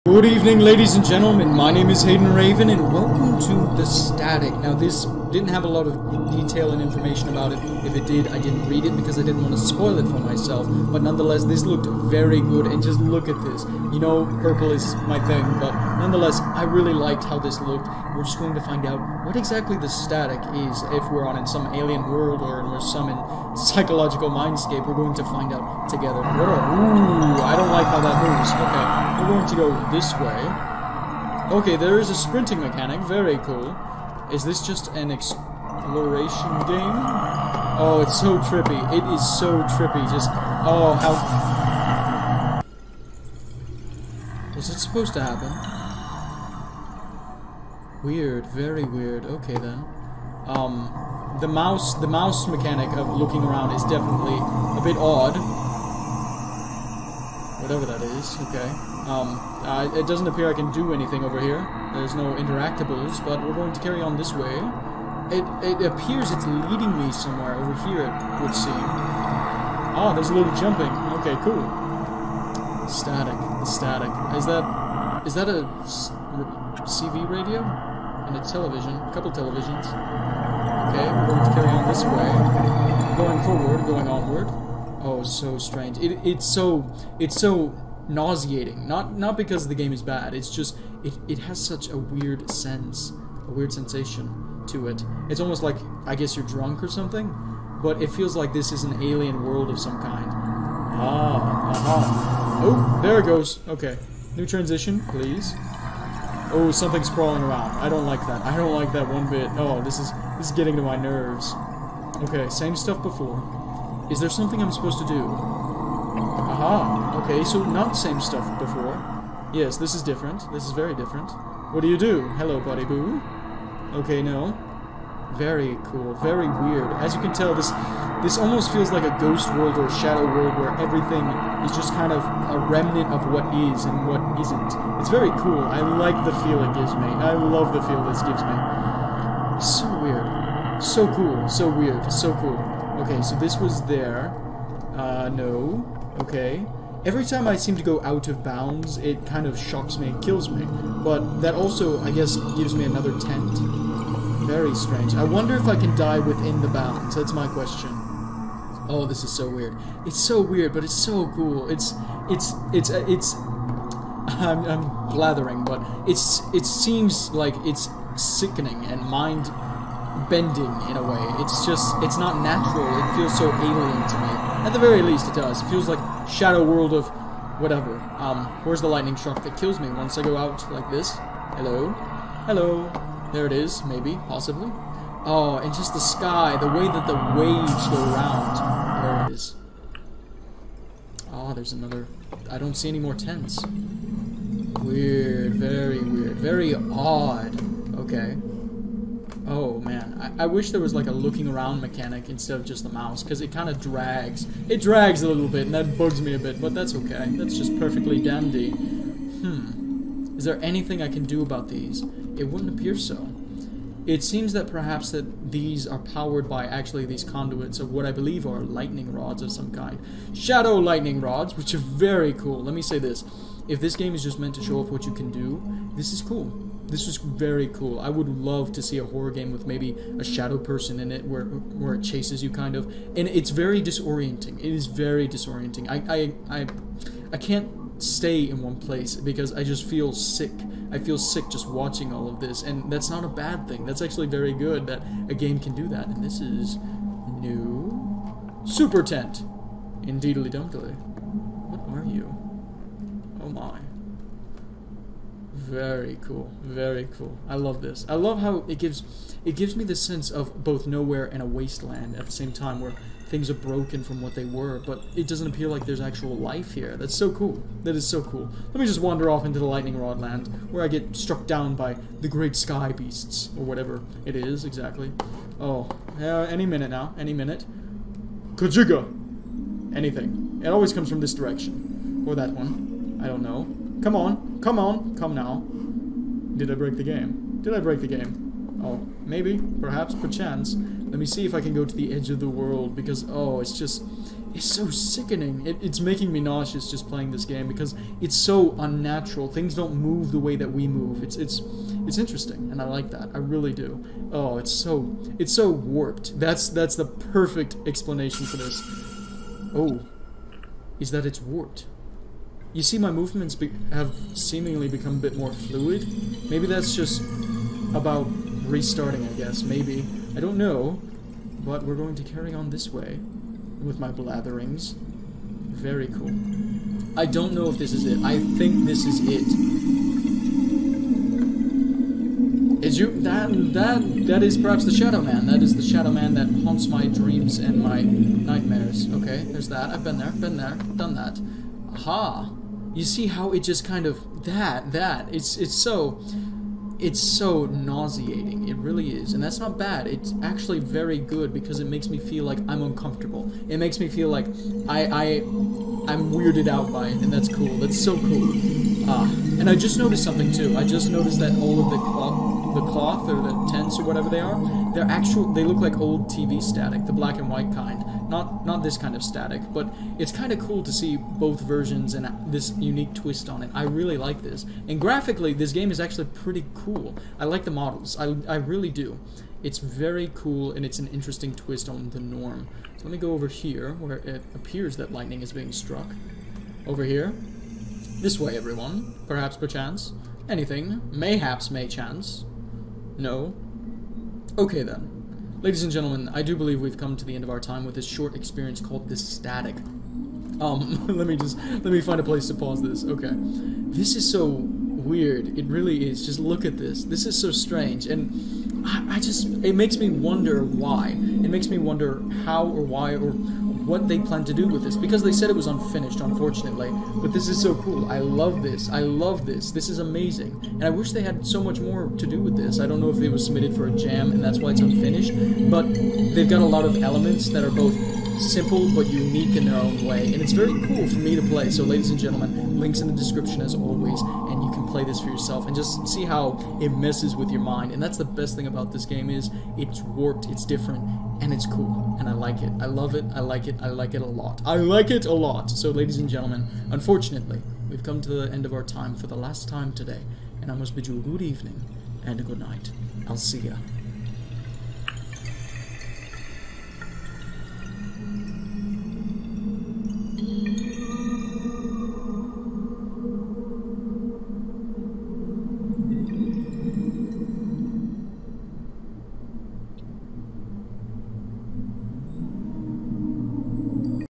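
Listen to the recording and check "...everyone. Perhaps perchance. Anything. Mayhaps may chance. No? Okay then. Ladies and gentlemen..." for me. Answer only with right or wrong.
right.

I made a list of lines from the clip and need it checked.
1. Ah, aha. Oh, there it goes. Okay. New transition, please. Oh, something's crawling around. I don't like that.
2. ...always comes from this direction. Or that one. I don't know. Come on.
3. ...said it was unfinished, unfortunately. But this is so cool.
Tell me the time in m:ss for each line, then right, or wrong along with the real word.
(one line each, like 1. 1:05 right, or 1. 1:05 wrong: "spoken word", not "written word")
1. 1:40 right
2. 4:40 right
3. 6:55 right.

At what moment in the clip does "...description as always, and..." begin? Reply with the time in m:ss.
7:13.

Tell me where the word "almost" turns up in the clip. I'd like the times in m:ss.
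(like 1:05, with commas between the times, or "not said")
1:35, 2:08.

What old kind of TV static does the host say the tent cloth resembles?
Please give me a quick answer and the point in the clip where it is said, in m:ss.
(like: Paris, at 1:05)
Black and white, at 6:07.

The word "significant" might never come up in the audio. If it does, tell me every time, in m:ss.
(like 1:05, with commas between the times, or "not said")
not said.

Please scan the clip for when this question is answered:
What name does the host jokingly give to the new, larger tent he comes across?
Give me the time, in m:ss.
4:08.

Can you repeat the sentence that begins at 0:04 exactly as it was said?
Now, this didn't have a lot of detail and information about it.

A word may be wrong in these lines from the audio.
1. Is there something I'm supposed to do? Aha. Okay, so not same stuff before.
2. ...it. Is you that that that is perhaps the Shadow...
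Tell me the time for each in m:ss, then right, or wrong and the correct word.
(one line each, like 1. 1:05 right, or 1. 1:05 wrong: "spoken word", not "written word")
1. 1:54 right
2. 5:29 right.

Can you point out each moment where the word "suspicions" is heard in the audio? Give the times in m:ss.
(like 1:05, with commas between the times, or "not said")
not said.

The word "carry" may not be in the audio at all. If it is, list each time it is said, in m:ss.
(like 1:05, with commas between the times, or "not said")
1:03, 1:21, 5:22.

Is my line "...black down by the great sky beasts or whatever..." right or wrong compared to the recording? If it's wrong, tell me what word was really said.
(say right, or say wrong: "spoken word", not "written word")
wrong: "struck", not "black".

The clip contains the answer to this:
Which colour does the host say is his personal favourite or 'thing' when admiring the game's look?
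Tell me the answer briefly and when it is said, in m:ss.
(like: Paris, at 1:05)
Purple, at 0:14.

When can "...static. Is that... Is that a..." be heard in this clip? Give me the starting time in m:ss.
1:13.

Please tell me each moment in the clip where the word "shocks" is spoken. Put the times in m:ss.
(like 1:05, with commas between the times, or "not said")
2:29.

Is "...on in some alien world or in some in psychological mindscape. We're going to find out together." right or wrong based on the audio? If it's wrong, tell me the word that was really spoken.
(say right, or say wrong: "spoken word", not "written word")
right.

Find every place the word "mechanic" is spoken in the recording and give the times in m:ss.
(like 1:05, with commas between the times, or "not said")
0:32, 0:52, 3:21.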